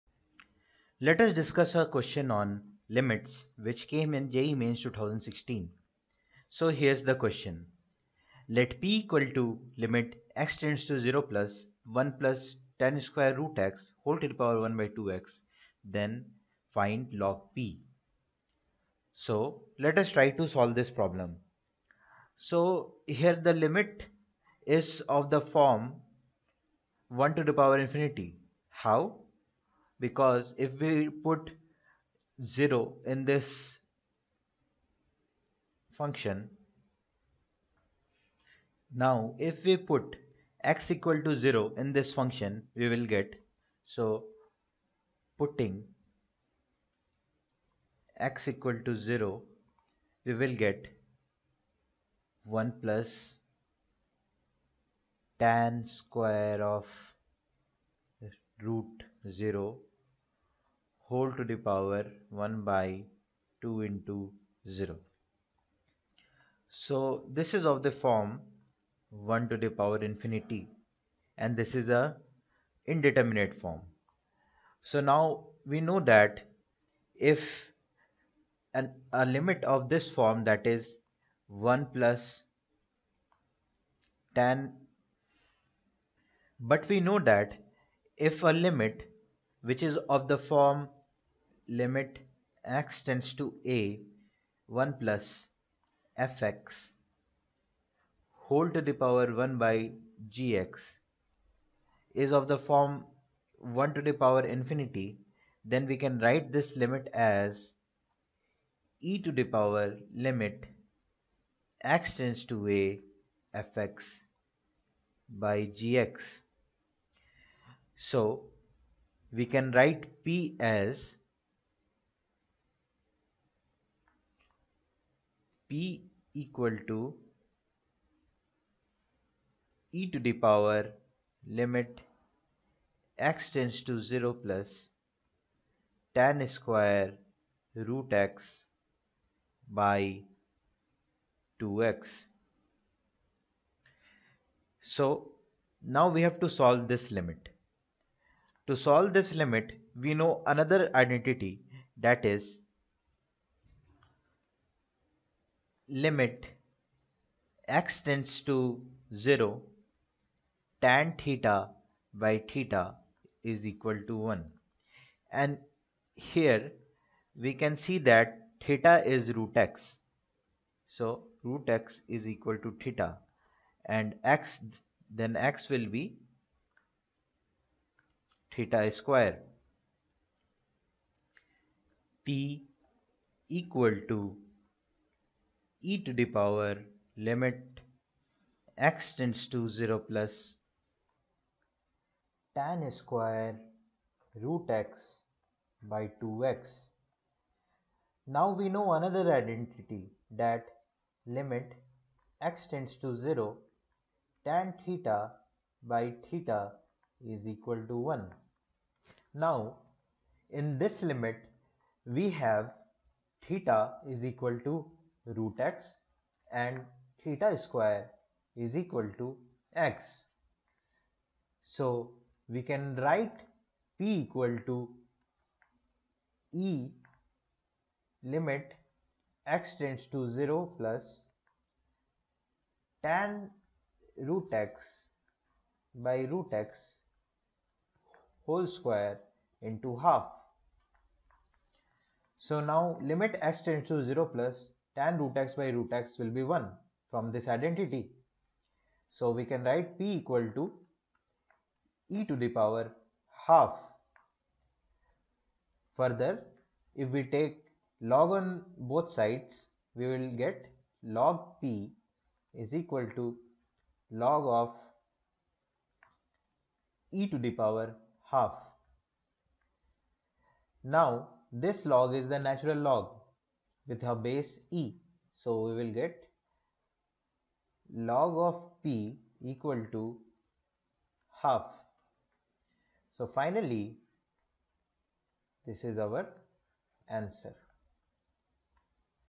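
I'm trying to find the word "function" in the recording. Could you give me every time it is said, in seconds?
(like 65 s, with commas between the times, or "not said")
36 s, 42 s.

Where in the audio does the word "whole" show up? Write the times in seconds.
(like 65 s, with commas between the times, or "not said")
14 s, 61 s, 98 s, 238 s.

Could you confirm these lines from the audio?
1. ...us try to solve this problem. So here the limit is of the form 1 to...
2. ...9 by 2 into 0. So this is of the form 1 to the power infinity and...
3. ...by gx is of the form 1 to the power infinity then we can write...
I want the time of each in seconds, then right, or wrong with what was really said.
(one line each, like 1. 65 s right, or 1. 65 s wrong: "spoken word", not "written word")
1. 19 s right
2. 62 s wrong: "1", not "9"
3. 99 s right.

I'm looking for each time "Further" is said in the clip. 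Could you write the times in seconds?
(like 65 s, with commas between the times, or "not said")
255 s.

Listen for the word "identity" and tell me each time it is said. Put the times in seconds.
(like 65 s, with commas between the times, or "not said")
151 s, 199 s, 247 s.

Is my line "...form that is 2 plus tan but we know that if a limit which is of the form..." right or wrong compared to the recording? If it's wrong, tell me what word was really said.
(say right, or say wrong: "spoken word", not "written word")
wrong: "1", not "2".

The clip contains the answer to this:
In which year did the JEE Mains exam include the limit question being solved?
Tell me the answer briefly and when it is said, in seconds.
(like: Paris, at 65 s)
2016, at 4 s.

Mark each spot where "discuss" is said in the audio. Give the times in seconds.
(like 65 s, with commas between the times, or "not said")
1 s.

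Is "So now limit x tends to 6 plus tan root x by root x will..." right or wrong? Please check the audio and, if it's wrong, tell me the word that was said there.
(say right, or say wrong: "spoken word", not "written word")
wrong: "0", not "6".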